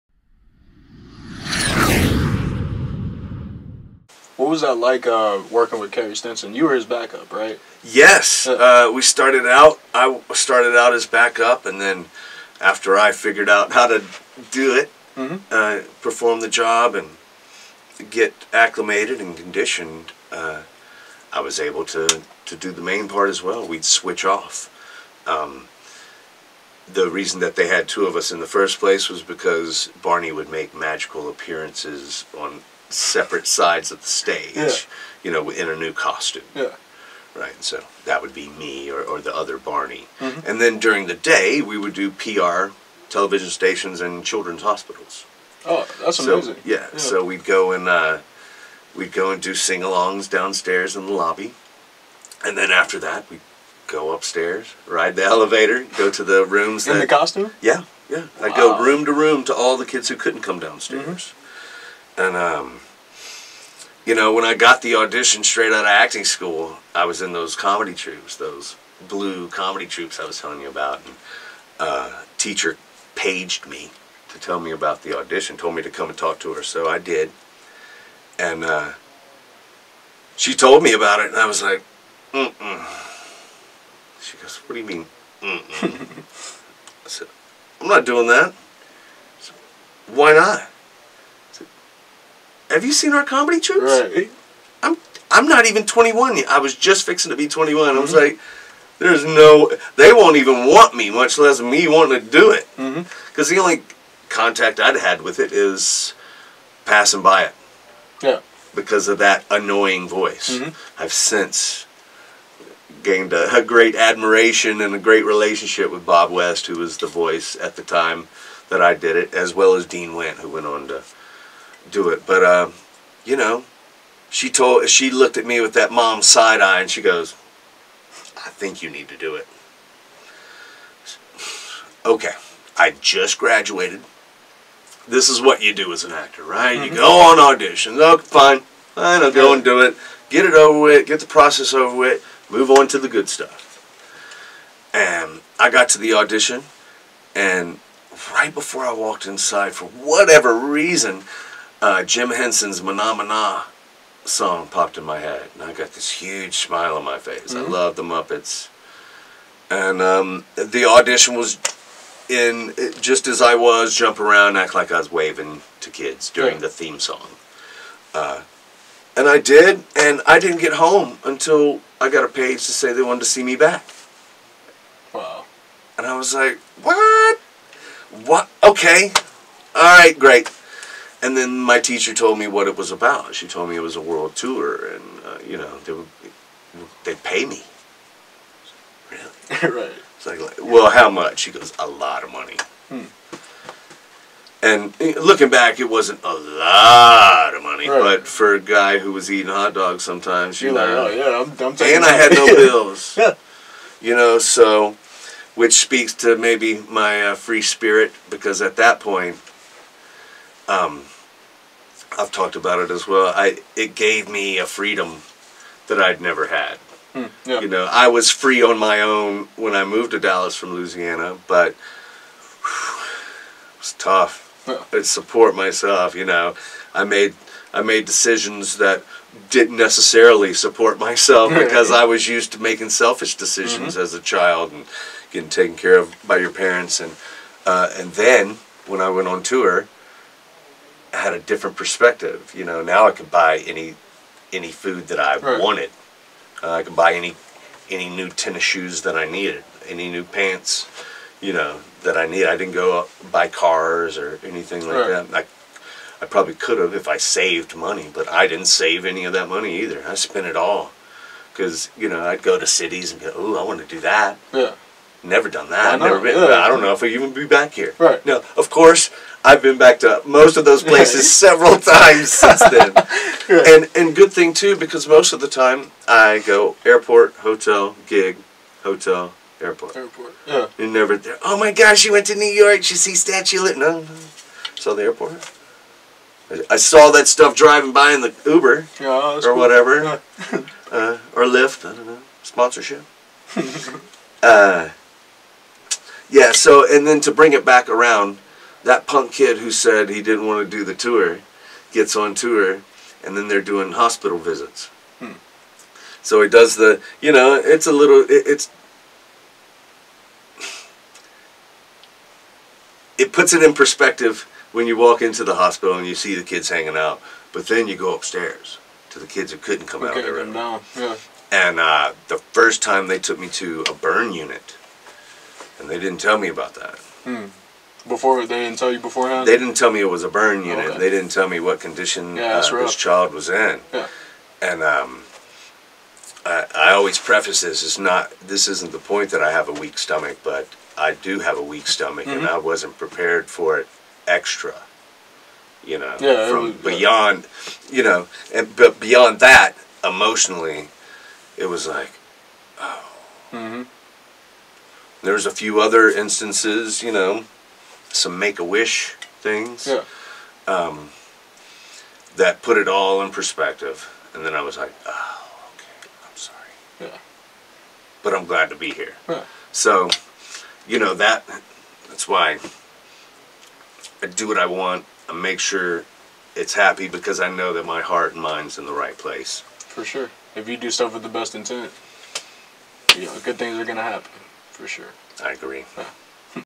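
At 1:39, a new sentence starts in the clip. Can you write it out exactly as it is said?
They won't even want me, much less me wanting to do it.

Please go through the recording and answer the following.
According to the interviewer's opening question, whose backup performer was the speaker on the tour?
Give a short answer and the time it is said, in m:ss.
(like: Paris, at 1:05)
Carey Stinson, at 0:05.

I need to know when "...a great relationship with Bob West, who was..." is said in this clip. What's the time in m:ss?
1:54.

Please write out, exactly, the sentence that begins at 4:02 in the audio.
You know, now I could buy any any food that I right.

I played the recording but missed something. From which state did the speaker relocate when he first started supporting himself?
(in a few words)
Louisiana.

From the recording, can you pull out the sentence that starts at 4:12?
I didn't go buy cars or anything like right.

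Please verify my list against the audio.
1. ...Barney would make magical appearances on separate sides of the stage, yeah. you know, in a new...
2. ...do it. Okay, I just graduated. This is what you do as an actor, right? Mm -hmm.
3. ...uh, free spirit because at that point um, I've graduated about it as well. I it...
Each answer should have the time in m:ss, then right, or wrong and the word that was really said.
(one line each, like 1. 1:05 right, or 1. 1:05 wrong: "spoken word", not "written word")
1. 0:30 right
2. 2:09 right
3. 3:27 wrong: "talked", not "graduated".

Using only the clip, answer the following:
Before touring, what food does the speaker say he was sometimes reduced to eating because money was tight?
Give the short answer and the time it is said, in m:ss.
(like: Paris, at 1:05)
hot dogs, at 3:19.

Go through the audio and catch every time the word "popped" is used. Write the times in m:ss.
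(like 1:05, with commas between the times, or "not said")
2:34.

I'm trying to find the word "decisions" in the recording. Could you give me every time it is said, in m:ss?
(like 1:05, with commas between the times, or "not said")
3:48, 3:53.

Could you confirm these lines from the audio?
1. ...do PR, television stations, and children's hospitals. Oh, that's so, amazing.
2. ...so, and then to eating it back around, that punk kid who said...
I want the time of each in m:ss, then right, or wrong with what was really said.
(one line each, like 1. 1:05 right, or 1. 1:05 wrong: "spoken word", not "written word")
1. 0:41 right
2. 4:56 wrong: "bring", not "eating".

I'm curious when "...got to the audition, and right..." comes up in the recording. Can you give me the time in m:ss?
2:25.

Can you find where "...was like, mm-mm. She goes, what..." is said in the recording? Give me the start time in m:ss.
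1:21.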